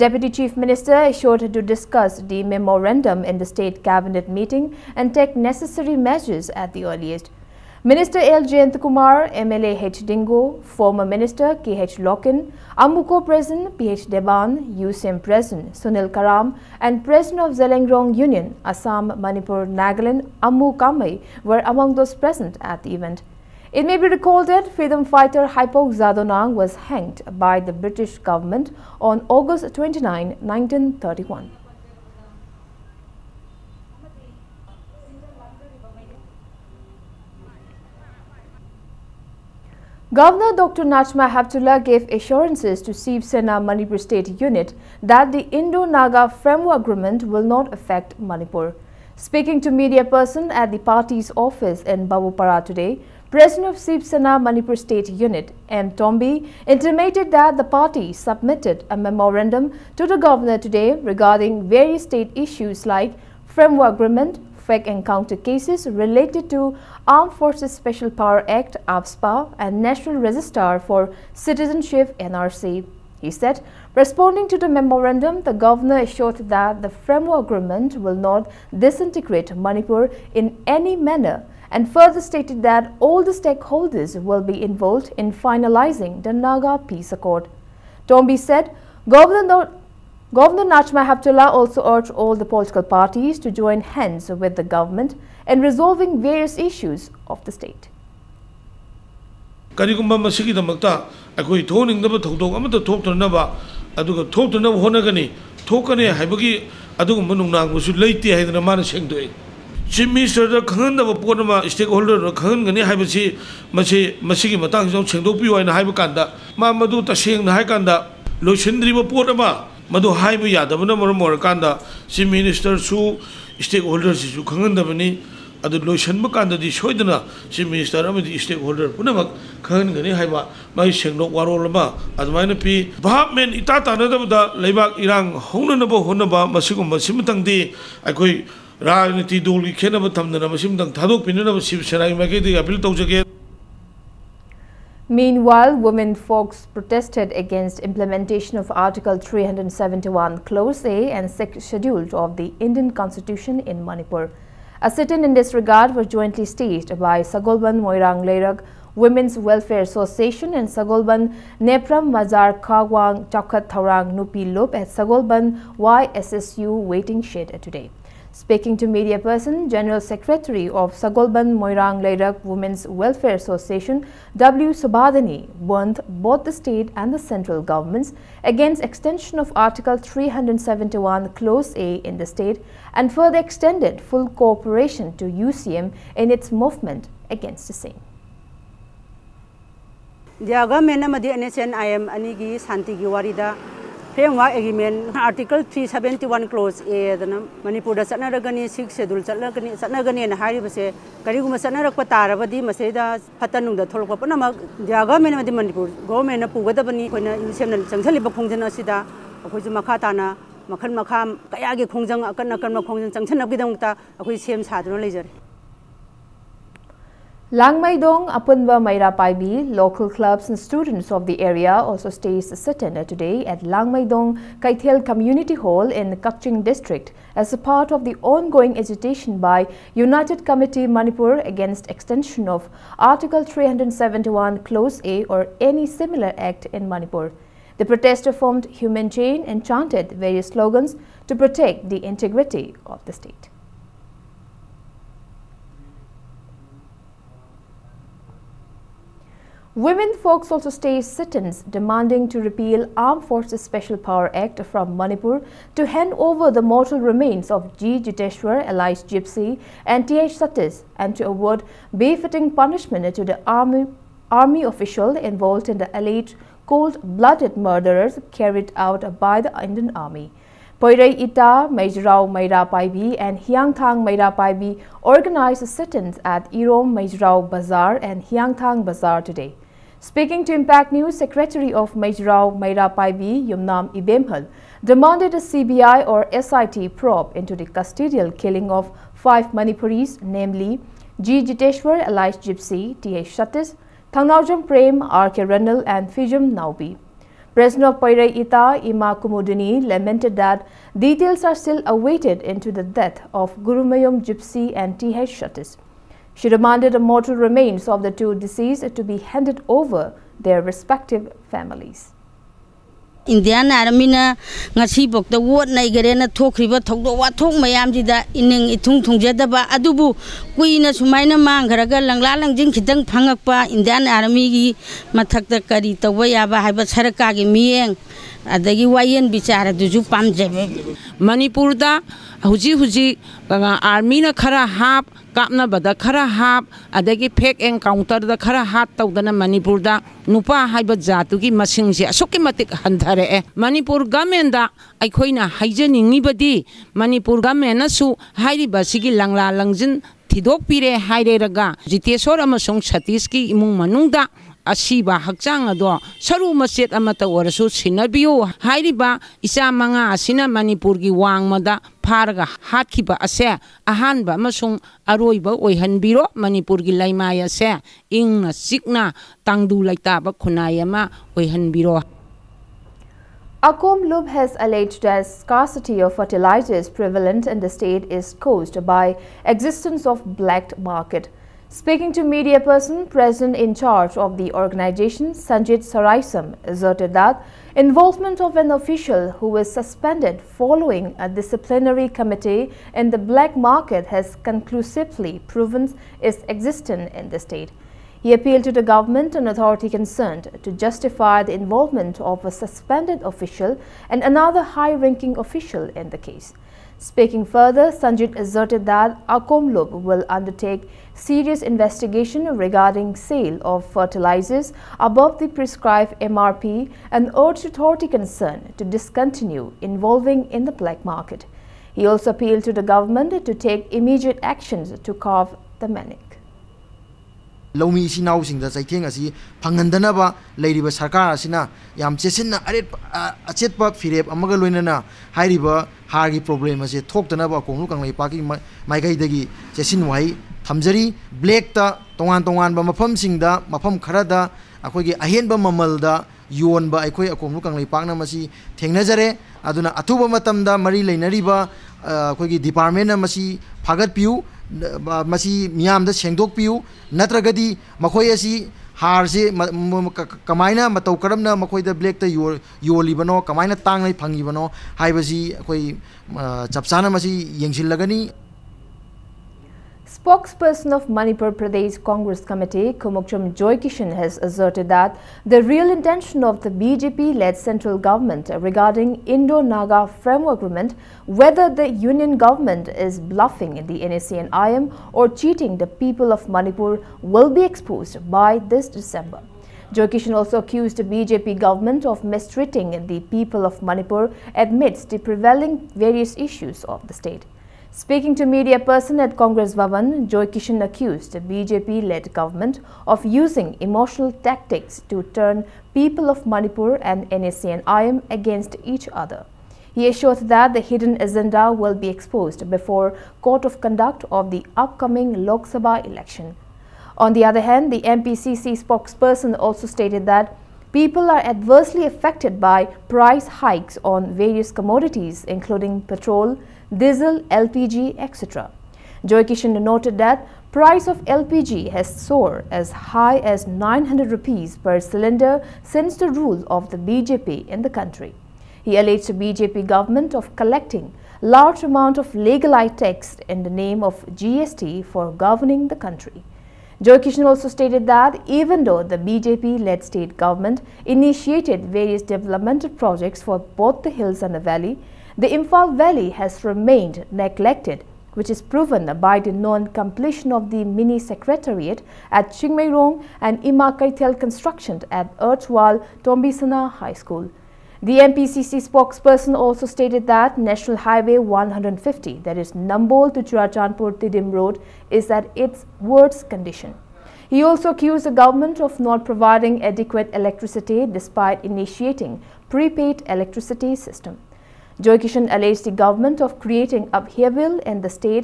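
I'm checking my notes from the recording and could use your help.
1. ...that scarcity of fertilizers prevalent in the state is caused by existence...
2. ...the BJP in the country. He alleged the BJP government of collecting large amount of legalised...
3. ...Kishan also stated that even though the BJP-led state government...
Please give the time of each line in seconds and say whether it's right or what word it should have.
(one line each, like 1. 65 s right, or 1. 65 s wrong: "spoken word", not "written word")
1. 375 s right
2. 536 s right
3. 547 s right.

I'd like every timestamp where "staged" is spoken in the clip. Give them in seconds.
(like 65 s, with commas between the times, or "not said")
156 s, 250 s.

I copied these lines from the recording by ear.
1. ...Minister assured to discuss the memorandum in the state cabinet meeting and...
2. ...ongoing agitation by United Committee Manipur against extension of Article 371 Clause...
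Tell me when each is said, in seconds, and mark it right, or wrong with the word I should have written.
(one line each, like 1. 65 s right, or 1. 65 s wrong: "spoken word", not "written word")
1. 0 s right
2. 228 s right.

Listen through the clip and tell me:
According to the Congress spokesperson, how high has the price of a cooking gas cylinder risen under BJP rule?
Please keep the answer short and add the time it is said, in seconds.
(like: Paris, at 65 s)
900 rupees, at 533 s.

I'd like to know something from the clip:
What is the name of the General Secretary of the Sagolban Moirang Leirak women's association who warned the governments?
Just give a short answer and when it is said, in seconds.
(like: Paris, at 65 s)
W. Subhadani, at 174 s.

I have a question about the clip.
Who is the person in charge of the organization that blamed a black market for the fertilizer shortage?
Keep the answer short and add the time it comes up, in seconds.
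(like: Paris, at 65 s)
Sanjit Saraisam, at 385 s.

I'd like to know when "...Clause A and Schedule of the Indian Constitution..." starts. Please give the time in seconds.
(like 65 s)
150 s.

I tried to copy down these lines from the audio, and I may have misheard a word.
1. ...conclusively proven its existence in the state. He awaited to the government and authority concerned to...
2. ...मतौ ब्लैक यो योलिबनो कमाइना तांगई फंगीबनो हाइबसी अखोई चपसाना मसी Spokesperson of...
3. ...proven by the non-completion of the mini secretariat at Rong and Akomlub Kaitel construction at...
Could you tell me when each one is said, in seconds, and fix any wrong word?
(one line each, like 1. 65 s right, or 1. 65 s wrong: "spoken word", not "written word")
1. 394 s wrong: "appealed", not "awaited"
2. 460 s right
3. 558 s wrong: "Ima", not "Akomlub".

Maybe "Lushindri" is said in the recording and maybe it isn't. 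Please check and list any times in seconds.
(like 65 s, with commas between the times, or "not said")
118 s.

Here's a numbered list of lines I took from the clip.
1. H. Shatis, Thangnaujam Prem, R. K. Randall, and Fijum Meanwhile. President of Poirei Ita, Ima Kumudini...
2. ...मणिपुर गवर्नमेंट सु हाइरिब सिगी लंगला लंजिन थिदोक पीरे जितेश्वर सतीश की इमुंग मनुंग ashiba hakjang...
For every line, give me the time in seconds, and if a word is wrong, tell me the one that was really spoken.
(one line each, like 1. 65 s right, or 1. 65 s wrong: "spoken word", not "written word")
1. 293 s wrong: "Naubi", not "Meanwhile"
2. 347 s right.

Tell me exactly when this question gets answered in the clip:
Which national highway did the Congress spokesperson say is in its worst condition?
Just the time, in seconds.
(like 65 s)
570 s.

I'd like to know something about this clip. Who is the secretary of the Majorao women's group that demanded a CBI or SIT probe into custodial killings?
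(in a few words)
Yumnam Ibemhal.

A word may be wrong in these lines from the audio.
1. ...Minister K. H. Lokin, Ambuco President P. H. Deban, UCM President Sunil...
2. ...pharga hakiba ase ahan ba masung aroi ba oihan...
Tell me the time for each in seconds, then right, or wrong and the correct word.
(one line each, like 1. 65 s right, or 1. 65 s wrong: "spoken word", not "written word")
1. 11 s right
2. 362 s right.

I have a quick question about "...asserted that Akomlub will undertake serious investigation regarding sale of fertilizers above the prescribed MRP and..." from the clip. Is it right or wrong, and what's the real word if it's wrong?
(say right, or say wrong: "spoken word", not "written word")
right.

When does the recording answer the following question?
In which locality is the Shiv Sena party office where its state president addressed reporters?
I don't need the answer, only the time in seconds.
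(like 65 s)
52 s.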